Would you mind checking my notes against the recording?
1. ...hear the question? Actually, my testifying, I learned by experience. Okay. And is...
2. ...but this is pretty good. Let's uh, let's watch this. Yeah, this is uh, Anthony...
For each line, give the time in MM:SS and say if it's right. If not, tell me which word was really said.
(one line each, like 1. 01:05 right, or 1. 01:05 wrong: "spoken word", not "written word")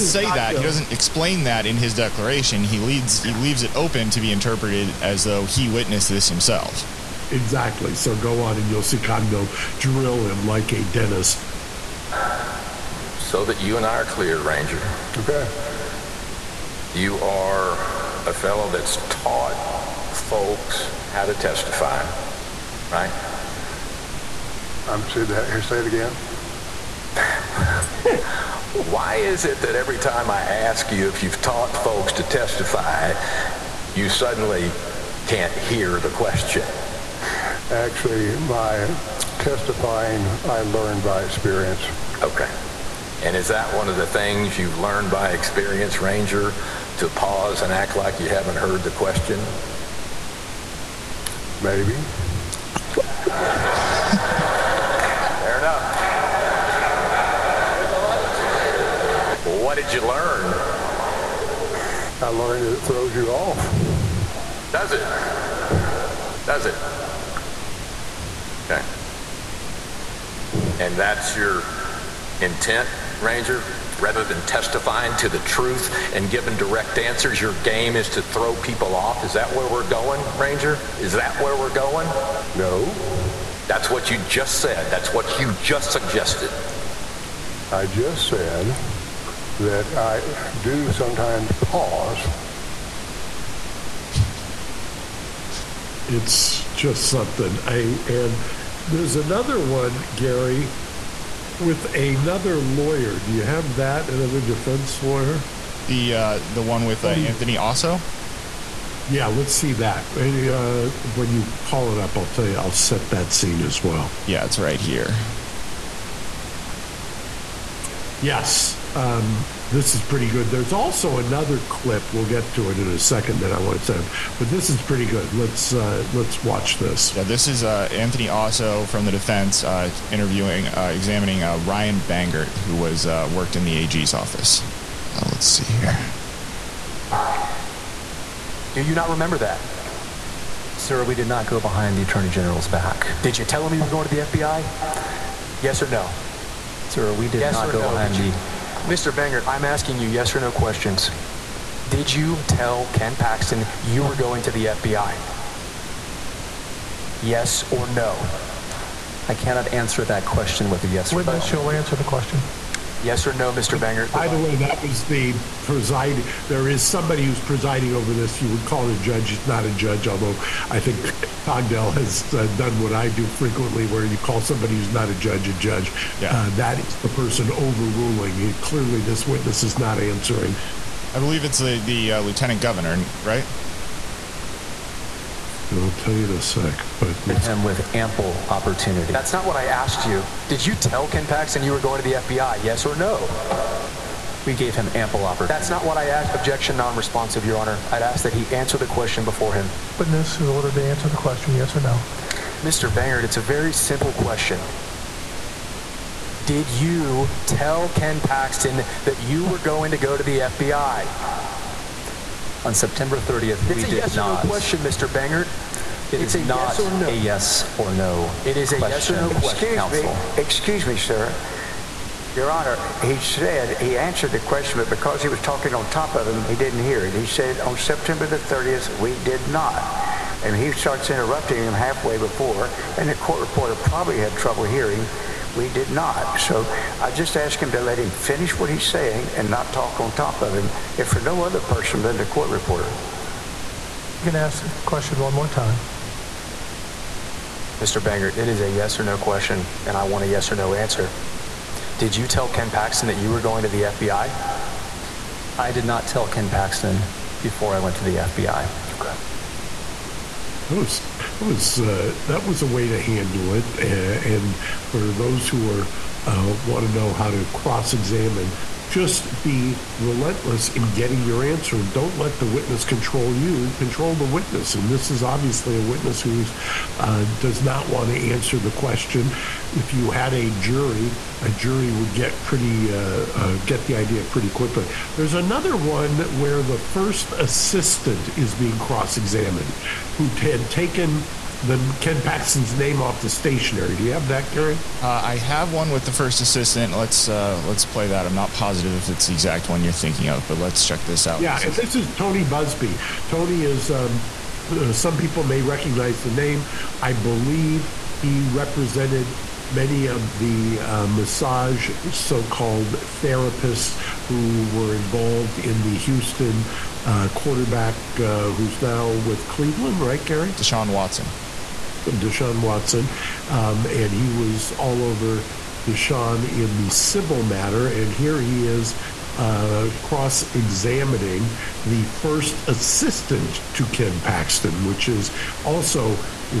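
1. 00:35 right
2. 02:04 right.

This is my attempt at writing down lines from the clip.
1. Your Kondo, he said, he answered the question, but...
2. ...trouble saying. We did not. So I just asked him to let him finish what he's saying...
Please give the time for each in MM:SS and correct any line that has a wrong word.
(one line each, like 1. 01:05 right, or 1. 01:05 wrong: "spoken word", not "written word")
1. 03:42 wrong: "Honor", not "Kondo"
2. 03:54 wrong: "hearing", not "saying".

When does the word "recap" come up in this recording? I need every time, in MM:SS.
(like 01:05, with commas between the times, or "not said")
not said.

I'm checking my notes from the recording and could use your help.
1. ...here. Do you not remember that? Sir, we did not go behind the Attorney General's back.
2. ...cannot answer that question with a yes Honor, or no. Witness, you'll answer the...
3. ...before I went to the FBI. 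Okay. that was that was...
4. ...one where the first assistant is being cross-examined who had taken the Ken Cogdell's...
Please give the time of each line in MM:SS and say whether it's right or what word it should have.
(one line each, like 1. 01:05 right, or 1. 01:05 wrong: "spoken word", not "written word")
1. 02:15 right
2. 02:39 wrong: "Witness", not "Honor"
3. 04:17 right
4. 04:45 wrong: "Paxton", not "Cogdell".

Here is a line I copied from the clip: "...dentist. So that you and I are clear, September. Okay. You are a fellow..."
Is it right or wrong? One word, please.
wrong.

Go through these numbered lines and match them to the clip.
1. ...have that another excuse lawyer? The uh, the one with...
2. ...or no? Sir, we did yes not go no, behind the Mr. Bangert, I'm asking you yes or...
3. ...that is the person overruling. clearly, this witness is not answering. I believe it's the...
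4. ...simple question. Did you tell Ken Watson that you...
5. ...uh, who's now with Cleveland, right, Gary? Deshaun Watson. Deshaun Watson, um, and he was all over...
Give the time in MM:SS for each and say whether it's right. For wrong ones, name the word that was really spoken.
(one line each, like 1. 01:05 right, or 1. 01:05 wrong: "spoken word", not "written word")
1. 01:43 wrong: "defense", not "excuse"
2. 02:25 right
3. 02:56 right
4. 03:23 wrong: "Paxton", not "Watson"
5. 05:18 right.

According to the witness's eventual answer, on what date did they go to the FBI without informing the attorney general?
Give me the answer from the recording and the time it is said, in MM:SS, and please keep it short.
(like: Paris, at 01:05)
September 30th, at 03:32.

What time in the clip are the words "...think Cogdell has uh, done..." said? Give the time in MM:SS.
02:50.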